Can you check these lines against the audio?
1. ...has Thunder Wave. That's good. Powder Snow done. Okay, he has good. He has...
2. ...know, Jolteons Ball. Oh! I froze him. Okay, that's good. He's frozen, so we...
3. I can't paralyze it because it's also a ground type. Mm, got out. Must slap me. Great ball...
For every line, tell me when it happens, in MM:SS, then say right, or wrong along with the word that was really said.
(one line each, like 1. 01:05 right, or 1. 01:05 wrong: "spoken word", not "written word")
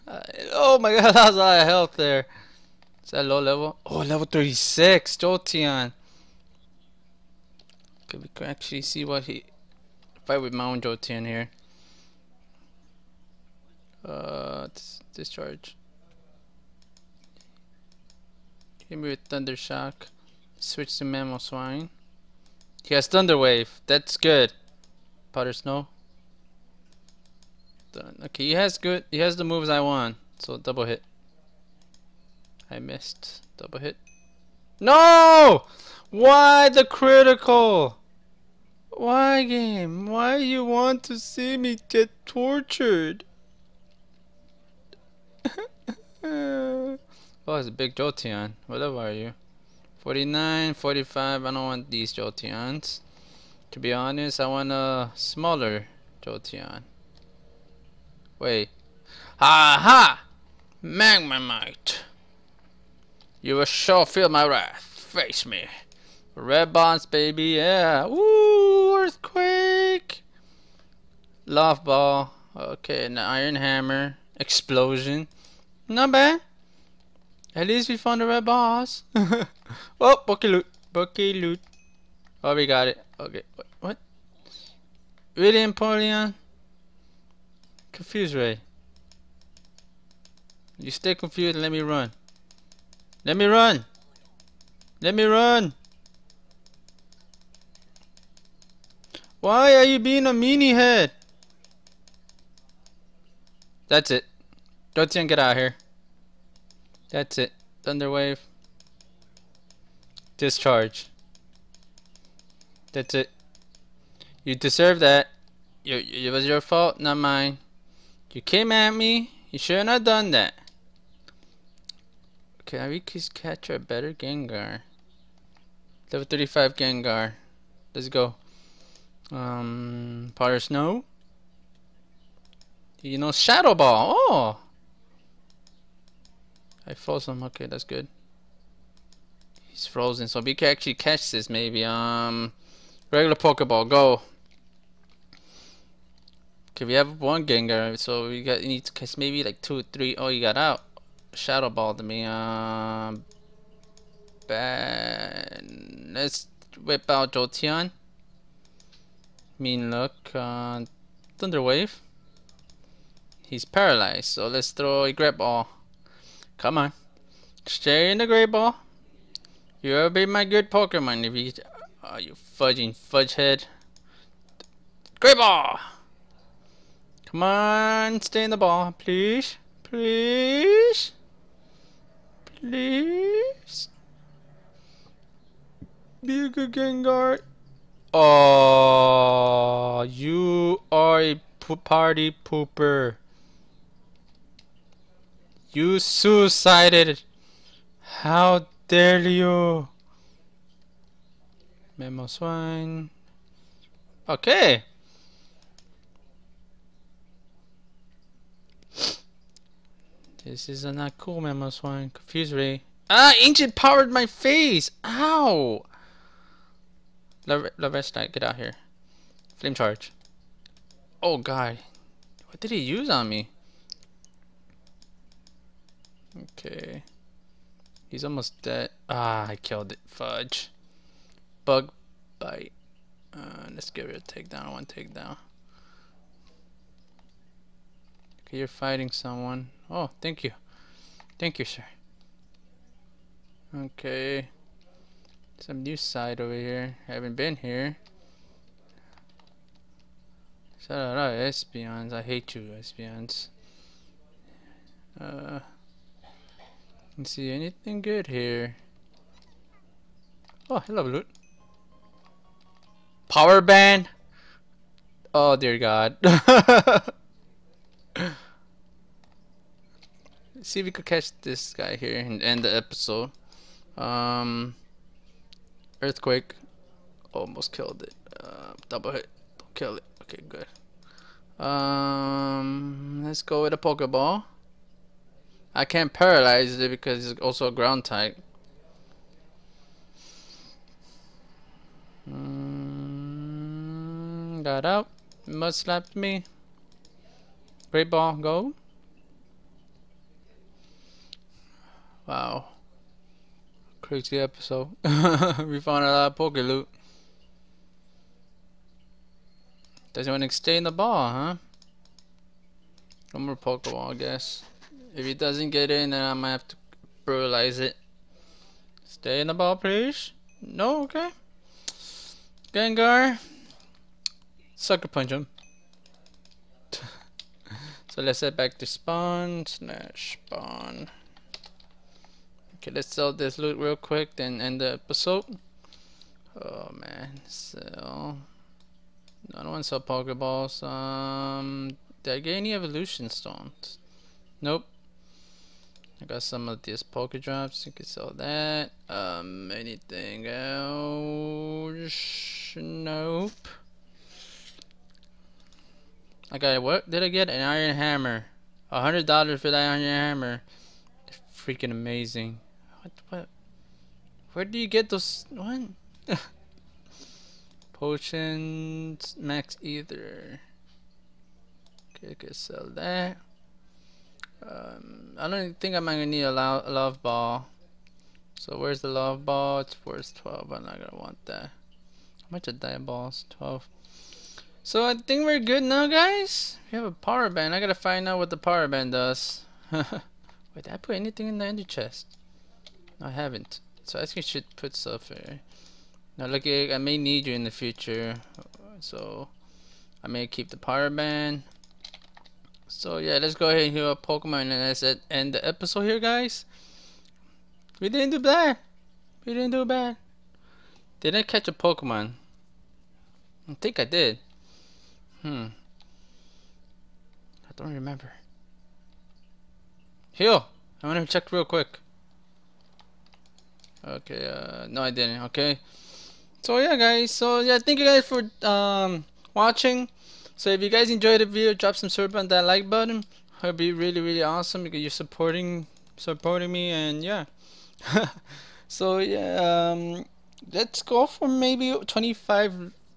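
1. 00:22 right
2. 02:13 wrong: "Shadow", not "Jolteons"
3. 04:45 right.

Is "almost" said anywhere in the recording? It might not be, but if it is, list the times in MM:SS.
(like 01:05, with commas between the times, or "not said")
03:48, 04:37.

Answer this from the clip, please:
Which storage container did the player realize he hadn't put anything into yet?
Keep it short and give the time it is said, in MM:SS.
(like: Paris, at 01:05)
Ender chest, at 06:31.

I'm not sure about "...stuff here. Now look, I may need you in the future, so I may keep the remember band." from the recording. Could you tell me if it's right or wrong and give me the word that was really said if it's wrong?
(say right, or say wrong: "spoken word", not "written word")
wrong: "power", not "remember".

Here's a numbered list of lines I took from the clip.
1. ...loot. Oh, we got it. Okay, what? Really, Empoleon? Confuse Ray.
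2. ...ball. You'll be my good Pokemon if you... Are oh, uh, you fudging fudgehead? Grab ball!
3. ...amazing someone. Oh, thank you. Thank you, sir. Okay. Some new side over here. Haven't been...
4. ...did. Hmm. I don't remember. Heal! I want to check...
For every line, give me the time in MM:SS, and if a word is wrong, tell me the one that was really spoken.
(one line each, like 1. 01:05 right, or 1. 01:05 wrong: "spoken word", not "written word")
1. 01:21 right
2. 02:48 right
3. 03:58 wrong: "fighting", not "amazing"
4. 06:54 right.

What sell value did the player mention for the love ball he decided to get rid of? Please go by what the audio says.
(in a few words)
12.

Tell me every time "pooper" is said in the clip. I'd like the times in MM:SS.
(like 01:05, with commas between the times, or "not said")
03:12.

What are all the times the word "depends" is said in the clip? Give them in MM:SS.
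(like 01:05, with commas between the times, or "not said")
not said.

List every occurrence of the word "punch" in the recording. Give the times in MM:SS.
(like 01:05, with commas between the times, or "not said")
05:25.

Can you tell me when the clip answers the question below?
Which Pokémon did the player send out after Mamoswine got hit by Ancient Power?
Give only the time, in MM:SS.
03:37.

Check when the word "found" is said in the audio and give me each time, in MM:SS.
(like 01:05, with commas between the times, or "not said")
01:17, 05:05.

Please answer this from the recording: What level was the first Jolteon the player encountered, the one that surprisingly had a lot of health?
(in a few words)
36.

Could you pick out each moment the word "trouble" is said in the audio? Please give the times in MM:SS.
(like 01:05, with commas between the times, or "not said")
not said.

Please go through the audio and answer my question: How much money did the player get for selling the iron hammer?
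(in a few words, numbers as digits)
$100.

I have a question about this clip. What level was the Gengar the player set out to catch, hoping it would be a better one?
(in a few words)
35.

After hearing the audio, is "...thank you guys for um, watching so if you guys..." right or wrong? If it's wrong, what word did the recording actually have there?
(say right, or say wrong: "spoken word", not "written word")
right.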